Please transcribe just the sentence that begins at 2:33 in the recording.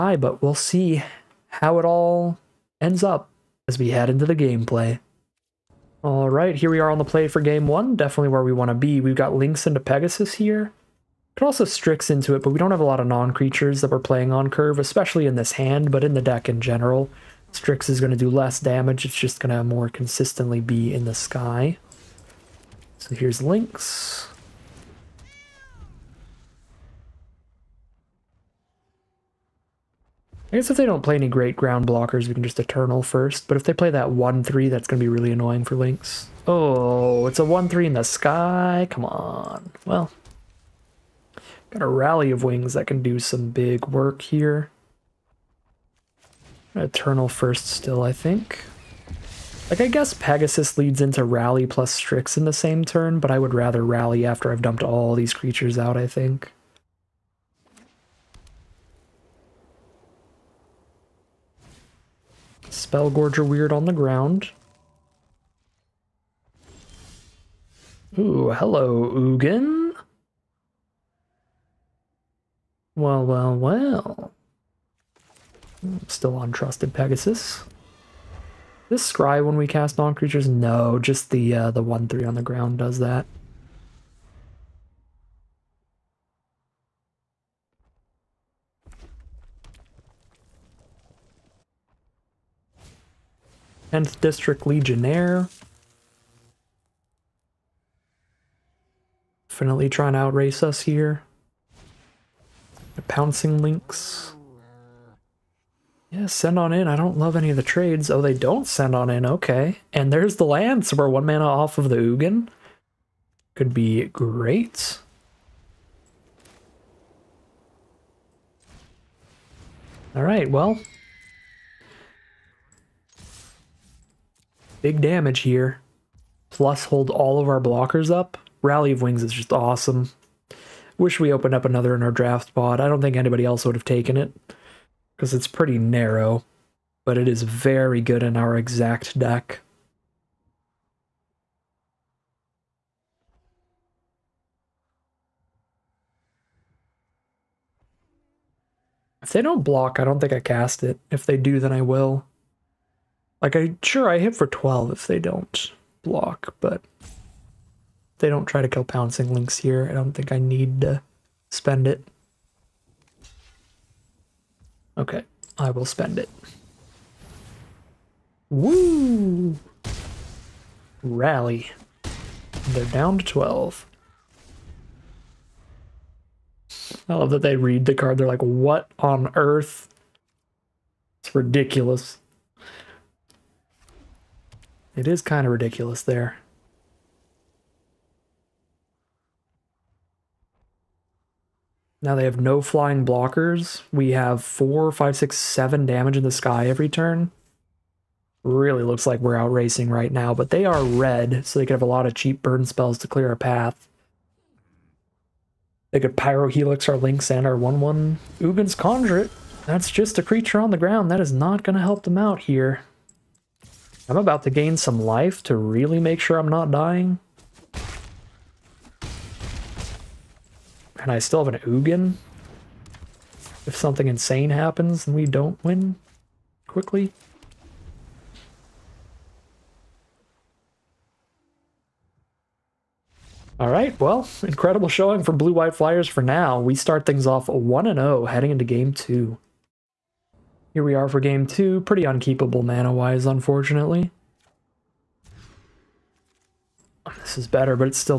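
Like, I sure I hit for 12 if they don't block, but they don't try to kill Pouncing Lynx here.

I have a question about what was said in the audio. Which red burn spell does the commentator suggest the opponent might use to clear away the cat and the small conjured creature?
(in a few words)
Pyro Helix.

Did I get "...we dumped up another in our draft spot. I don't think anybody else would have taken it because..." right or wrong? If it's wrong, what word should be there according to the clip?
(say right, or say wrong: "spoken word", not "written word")
wrong: "opened", not "dumped".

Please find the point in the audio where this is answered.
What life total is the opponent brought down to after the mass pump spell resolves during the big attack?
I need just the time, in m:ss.
2:52.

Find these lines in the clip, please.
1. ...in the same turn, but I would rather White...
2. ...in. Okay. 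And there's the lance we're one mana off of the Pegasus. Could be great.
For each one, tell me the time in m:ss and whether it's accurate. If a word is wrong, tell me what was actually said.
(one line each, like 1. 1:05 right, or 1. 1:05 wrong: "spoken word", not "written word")
1. 0:52 wrong: "Rally", not "White"
2. 1:49 wrong: "Ugin", not "Pegasus".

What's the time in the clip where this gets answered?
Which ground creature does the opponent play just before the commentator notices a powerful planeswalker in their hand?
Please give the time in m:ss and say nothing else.
1:02.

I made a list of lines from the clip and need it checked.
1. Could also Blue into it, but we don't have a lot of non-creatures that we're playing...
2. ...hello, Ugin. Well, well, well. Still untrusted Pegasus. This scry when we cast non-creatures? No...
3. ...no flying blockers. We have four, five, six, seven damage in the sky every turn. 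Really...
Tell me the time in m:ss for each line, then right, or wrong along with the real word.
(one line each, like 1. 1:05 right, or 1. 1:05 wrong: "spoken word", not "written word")
1. 0:11 wrong: "Strix", not "Blue"
2. 1:08 right
3. 3:12 right.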